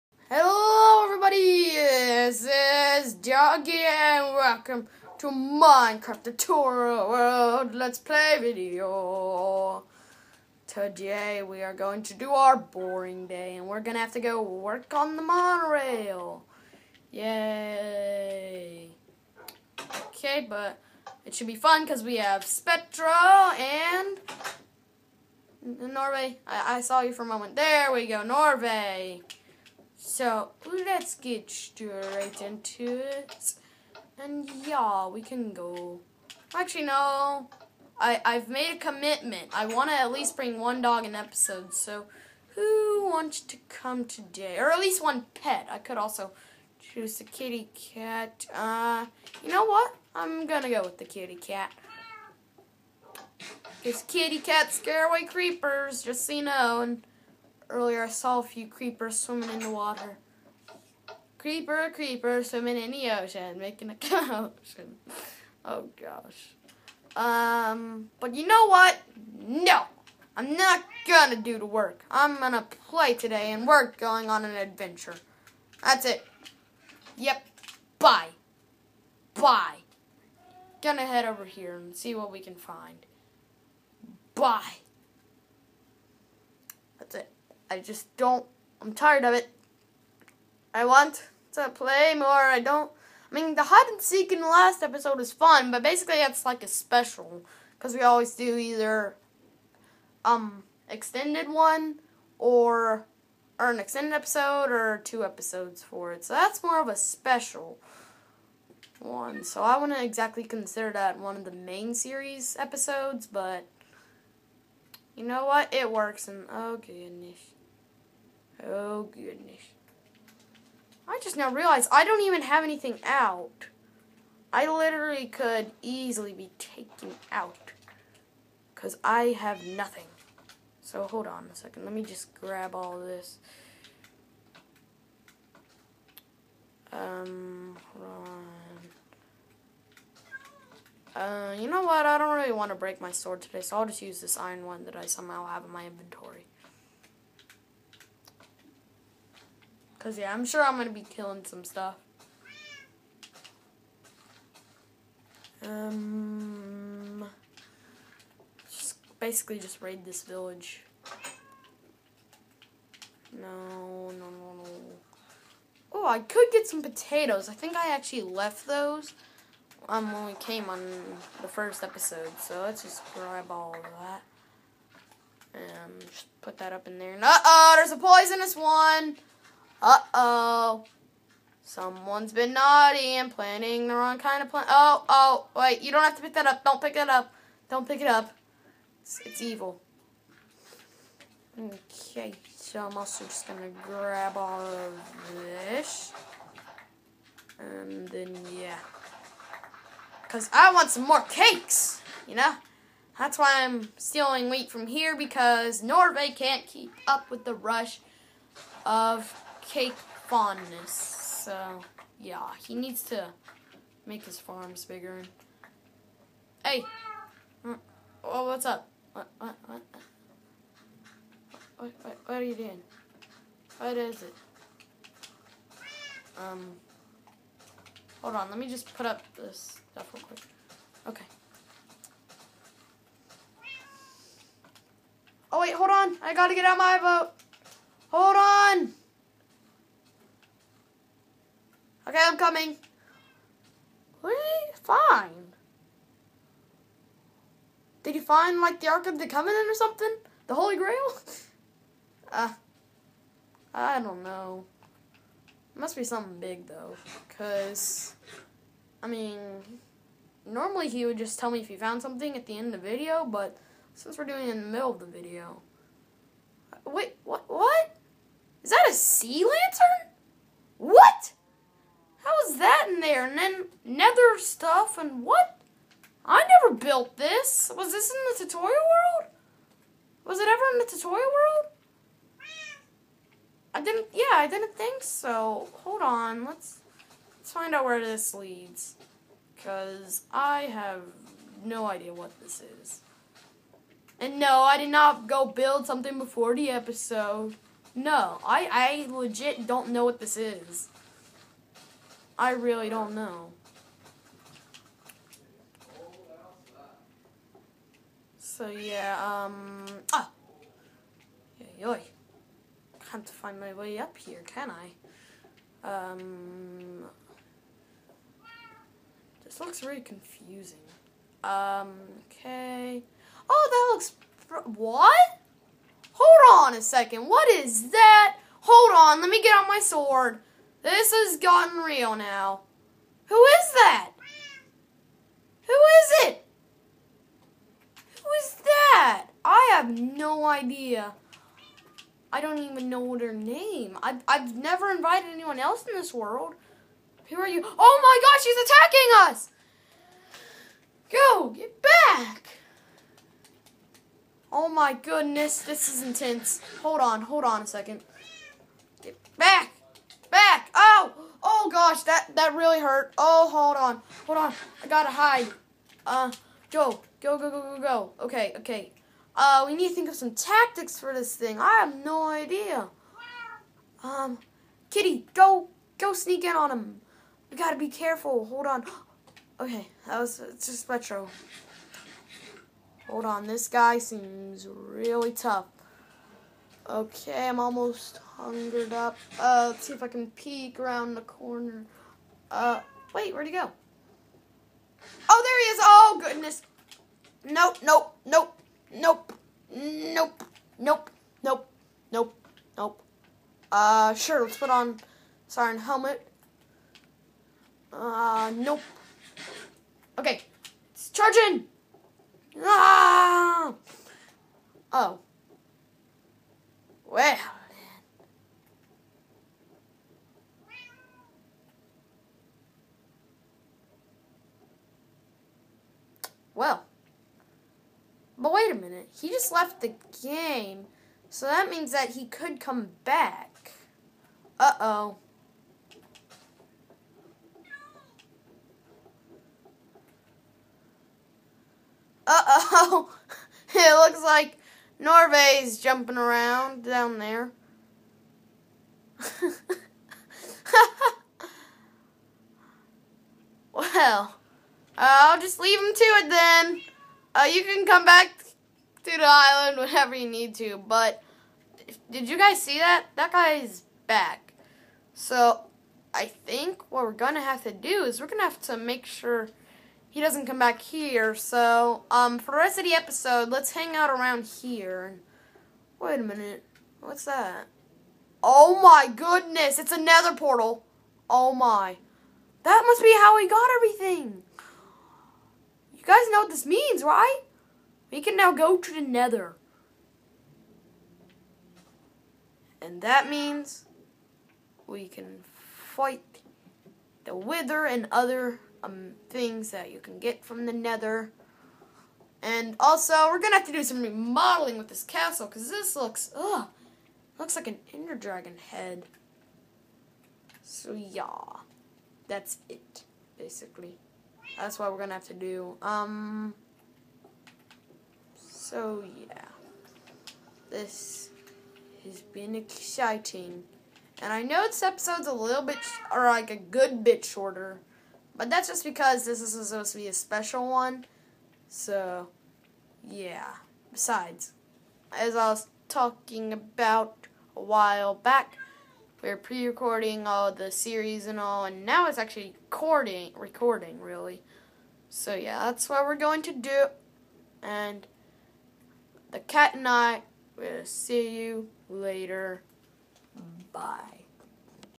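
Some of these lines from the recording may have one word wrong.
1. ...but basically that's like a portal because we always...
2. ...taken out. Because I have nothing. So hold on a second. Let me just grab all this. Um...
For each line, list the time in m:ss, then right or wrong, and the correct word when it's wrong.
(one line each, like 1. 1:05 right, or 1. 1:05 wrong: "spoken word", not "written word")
1. 1:35 wrong: "special", not "portal"
2. 2:06 right.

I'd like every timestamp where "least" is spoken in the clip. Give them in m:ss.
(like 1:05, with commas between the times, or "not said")
0:40, 0:44.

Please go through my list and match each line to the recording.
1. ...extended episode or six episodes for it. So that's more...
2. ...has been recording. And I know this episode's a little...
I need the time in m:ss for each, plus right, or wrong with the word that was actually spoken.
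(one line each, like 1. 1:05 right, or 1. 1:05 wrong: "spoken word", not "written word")
1. 1:43 wrong: "two", not "six"
2. 8:42 wrong: "exciting", not "recording".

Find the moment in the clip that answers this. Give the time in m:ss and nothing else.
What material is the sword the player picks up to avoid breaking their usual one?
2:24.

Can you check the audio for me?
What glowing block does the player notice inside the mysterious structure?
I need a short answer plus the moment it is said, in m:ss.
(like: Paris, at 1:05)
sea lantern, at 4:28.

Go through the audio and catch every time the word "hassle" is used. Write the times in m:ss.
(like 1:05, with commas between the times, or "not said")
not said.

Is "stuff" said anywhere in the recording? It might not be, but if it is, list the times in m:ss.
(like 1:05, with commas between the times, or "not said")
2:31, 3:49, 4:34.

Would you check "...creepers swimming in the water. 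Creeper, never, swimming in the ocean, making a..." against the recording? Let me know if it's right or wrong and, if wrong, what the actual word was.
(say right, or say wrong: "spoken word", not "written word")
wrong: "creeper", not "never".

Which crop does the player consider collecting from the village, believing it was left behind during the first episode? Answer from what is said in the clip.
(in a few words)
potatoes.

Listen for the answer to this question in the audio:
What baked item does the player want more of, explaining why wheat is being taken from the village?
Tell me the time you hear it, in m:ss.
3:21.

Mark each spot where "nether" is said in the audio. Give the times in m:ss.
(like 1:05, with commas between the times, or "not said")
4:33, 8:09, 8:20.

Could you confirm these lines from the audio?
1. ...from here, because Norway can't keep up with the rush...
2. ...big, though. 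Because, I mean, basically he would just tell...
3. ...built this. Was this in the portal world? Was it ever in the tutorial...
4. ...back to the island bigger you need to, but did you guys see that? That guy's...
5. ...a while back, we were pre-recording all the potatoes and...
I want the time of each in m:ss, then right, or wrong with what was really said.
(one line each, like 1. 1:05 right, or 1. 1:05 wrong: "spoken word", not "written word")
1. 3:24 right
2. 4:16 wrong: "normally", not "basically"
3. 4:36 wrong: "tutorial", not "portal"
4. 7:38 wrong: "whenever", not "bigger"
5. 8:57 wrong: "series", not "potatoes".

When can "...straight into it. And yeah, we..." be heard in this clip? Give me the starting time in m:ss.
0:31.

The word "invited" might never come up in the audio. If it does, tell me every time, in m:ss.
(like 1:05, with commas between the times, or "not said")
5:44.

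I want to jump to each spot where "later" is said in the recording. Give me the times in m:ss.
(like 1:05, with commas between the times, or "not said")
9:11.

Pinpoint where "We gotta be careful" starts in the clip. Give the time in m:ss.
6:17.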